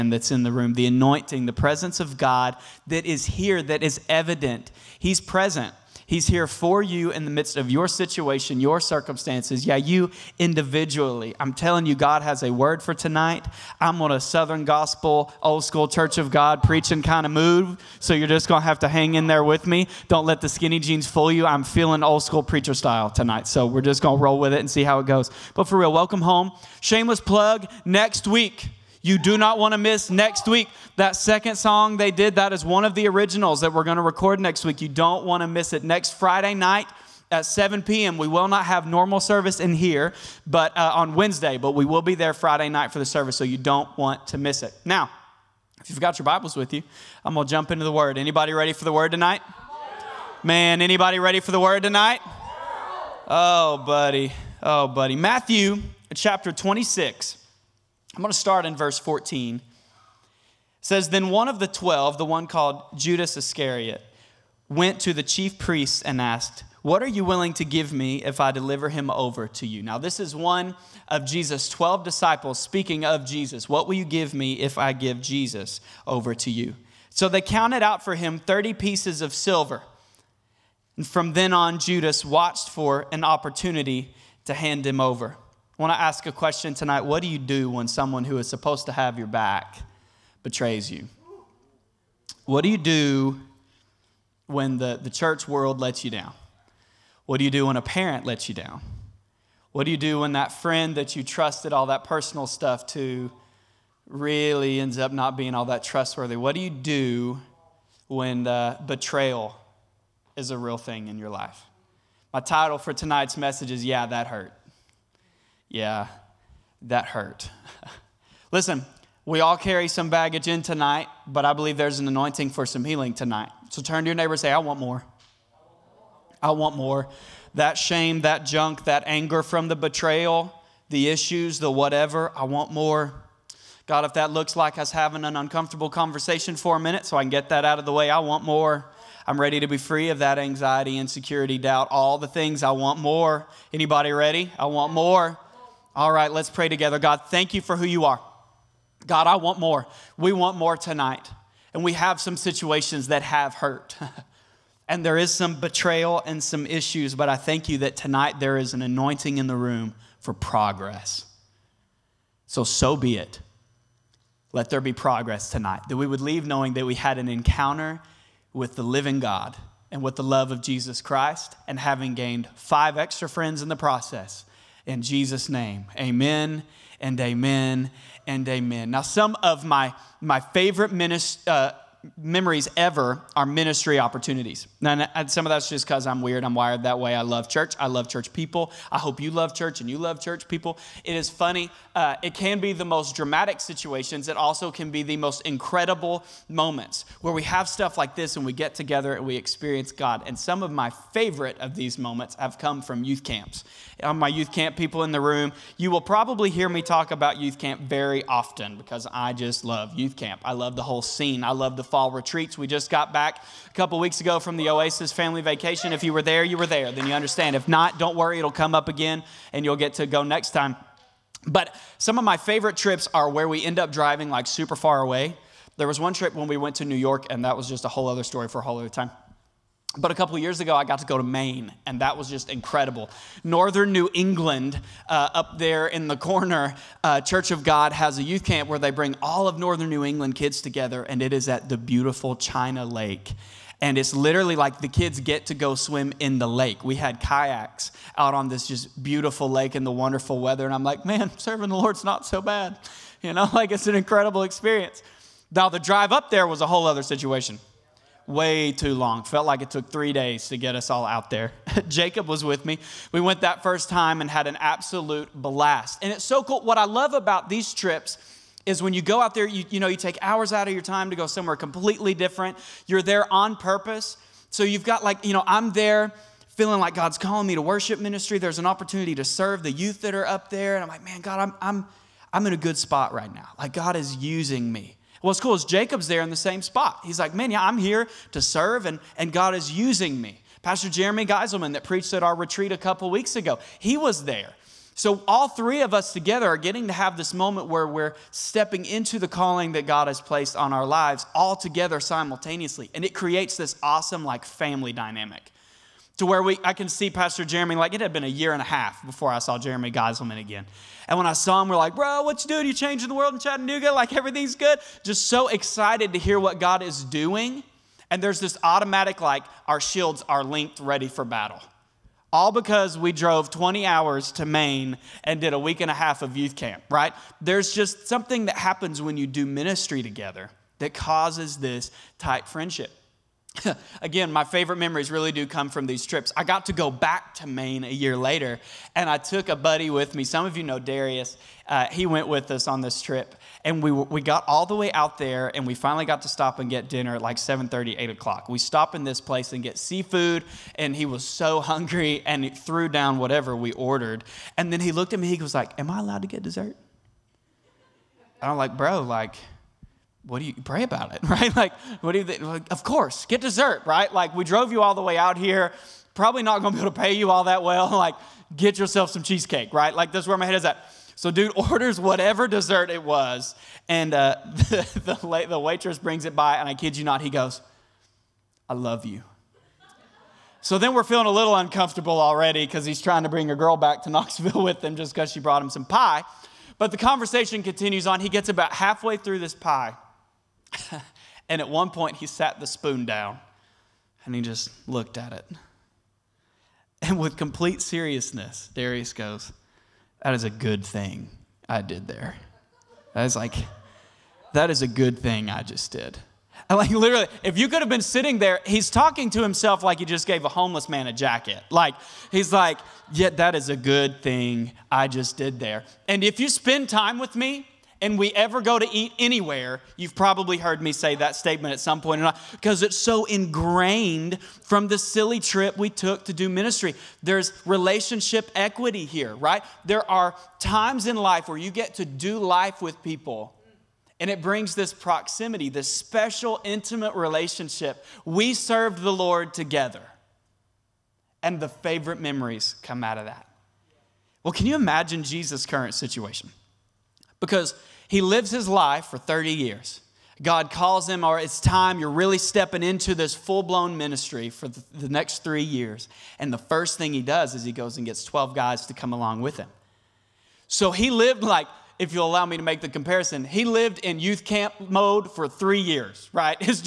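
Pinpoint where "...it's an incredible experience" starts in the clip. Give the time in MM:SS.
04:13.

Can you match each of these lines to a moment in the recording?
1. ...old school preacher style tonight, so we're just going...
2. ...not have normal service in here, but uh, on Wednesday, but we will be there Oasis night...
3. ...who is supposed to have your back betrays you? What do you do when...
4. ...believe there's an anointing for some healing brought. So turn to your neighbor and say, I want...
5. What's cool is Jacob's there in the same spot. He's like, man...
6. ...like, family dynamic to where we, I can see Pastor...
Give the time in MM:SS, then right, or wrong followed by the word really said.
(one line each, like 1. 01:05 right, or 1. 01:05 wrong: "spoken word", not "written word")
1. 00:22 right
2. 00:38 wrong: "Friday", not "Oasis"
3. 01:28 right
4. 02:01 wrong: "tonight", not "brought"
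5. 04:45 right
6. 05:04 right.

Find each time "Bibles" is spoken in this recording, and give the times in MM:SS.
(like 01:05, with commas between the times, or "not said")
00:46.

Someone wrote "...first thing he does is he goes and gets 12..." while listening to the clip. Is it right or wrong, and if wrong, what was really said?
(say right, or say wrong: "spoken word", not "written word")
right.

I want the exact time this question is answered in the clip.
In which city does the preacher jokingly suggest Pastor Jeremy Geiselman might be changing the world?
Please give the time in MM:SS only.
05:13.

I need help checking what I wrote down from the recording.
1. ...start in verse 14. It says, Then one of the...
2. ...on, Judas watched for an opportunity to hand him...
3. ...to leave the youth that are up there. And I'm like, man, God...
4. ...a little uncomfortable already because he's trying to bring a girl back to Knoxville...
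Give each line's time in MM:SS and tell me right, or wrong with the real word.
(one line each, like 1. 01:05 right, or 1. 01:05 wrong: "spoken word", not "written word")
1. 00:58 right
2. 01:21 right
3. 04:39 wrong: "serve", not "leave"
4. 06:21 right.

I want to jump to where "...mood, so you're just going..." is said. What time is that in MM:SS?
00:17.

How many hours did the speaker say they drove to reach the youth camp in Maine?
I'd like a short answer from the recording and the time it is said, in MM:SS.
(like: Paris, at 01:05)
20, at 05:23.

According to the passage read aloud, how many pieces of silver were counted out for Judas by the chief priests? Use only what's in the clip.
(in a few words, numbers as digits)
30.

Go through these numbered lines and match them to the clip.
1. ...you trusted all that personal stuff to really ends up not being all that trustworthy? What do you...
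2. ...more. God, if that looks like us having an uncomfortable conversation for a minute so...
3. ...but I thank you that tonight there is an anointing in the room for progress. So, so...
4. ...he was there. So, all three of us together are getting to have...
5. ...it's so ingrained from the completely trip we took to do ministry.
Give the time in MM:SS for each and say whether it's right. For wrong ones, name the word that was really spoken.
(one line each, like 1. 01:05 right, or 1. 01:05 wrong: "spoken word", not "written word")
1. 01:41 right
2. 02:12 right
3. 02:37 right
4. 04:53 right
5. 07:02 wrong: "silly", not "completely".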